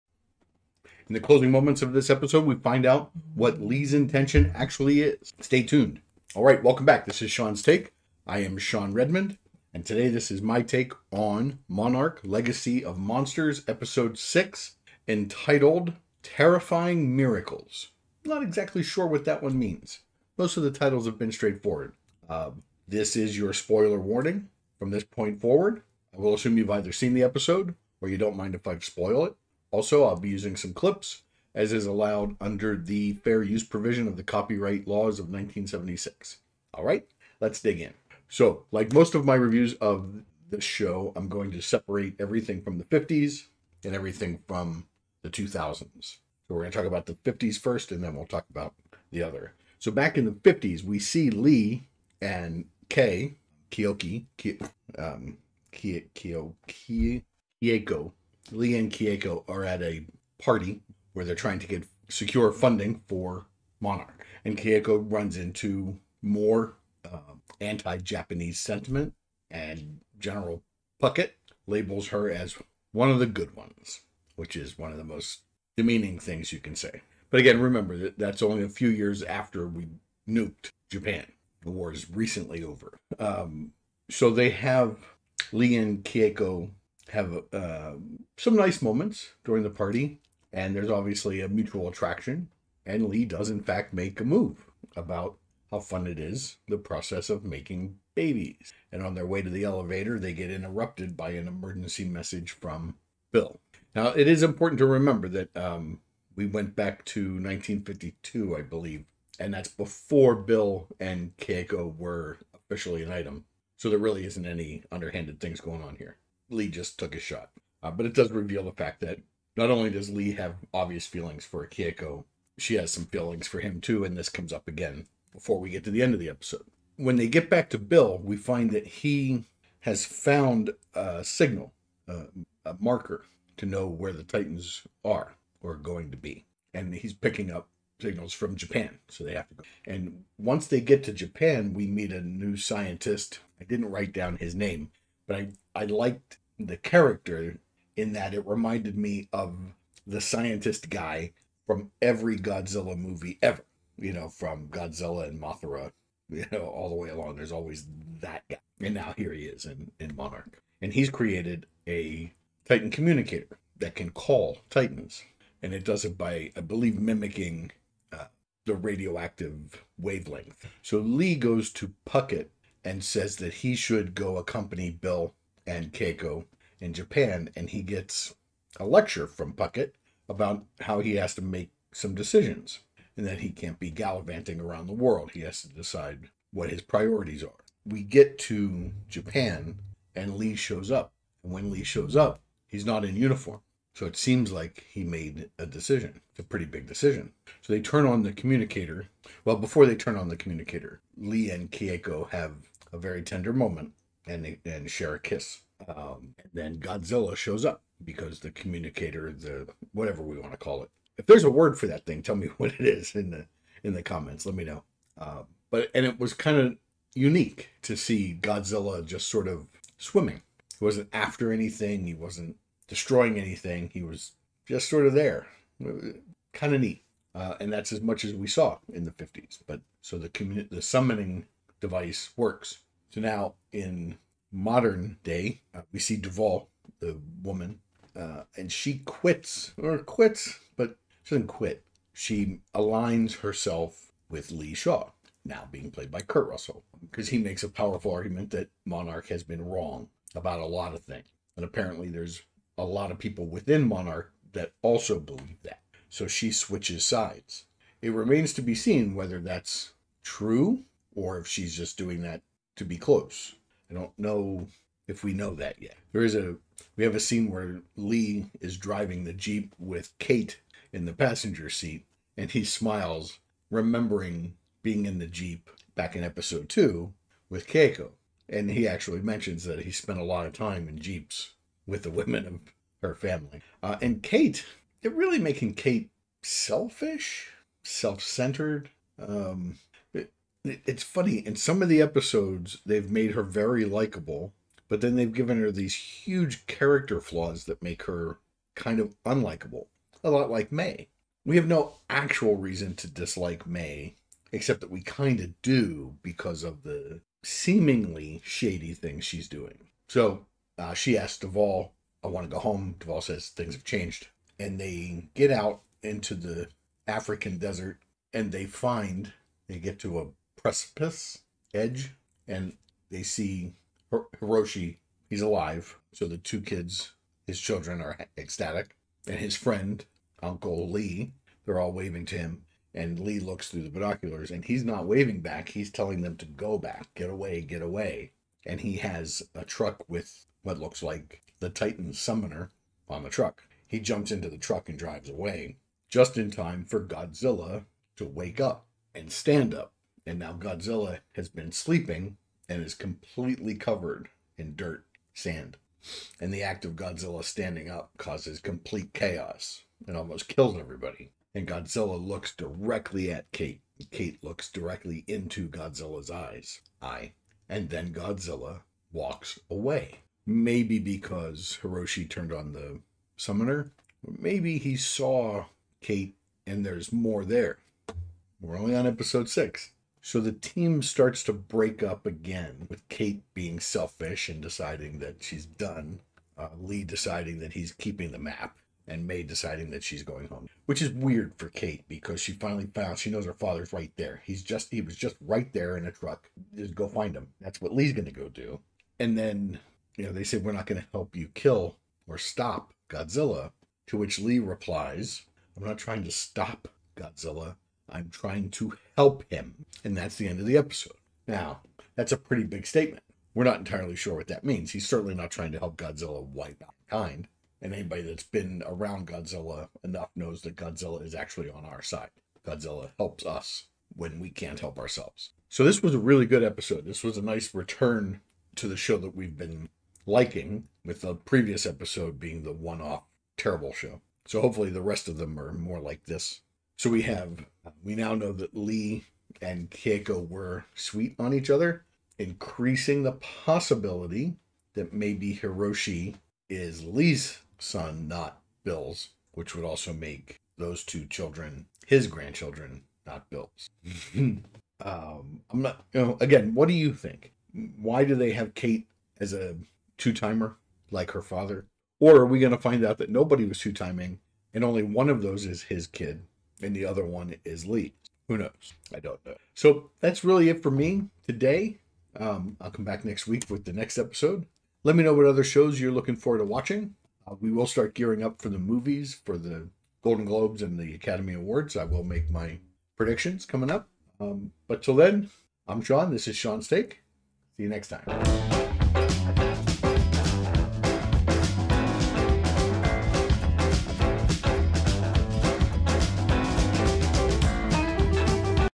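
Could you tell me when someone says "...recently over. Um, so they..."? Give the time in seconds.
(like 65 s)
82 s.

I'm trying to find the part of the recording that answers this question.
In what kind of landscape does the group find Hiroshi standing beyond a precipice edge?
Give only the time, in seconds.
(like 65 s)
317 s.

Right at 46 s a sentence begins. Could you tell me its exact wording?
So, we're going to talk about the 50s first, and then we'll talk about the other.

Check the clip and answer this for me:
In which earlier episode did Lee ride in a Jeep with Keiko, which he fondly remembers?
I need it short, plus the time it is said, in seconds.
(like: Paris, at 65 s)
episode 2, at 276 s.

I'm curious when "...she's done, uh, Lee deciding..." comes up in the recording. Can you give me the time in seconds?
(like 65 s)
385 s.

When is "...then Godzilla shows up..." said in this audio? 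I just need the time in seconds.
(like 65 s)
206 s.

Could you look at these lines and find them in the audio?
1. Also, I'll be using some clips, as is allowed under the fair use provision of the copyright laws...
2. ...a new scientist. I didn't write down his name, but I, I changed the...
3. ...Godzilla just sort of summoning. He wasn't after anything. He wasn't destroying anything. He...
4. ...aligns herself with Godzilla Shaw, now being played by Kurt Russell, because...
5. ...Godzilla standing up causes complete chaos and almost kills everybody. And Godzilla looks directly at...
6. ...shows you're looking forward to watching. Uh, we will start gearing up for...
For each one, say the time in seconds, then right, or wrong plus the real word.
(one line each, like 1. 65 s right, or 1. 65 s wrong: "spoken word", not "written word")
1. 29 s right
2. 142 s wrong: "liked", not "changed"
3. 218 s wrong: "swimming", not "summoning"
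4. 242 s wrong: "Lee", not "Godzilla"
5. 356 s right
6. 475 s right.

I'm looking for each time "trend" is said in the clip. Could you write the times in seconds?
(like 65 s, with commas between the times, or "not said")
not said.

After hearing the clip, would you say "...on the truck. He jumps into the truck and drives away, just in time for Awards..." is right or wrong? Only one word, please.
wrong.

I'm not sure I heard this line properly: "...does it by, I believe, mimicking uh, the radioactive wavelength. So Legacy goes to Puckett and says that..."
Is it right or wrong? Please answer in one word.
wrong.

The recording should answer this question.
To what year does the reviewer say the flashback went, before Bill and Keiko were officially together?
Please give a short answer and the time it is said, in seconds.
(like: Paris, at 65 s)
1952, at 107 s.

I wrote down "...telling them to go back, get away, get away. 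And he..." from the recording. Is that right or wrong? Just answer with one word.
right.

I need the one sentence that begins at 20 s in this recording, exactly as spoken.
Most of the titles have been straightforward.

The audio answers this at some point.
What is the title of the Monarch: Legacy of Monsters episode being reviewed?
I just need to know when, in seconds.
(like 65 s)
16 s.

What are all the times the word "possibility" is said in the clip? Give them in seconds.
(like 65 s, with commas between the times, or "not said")
443 s.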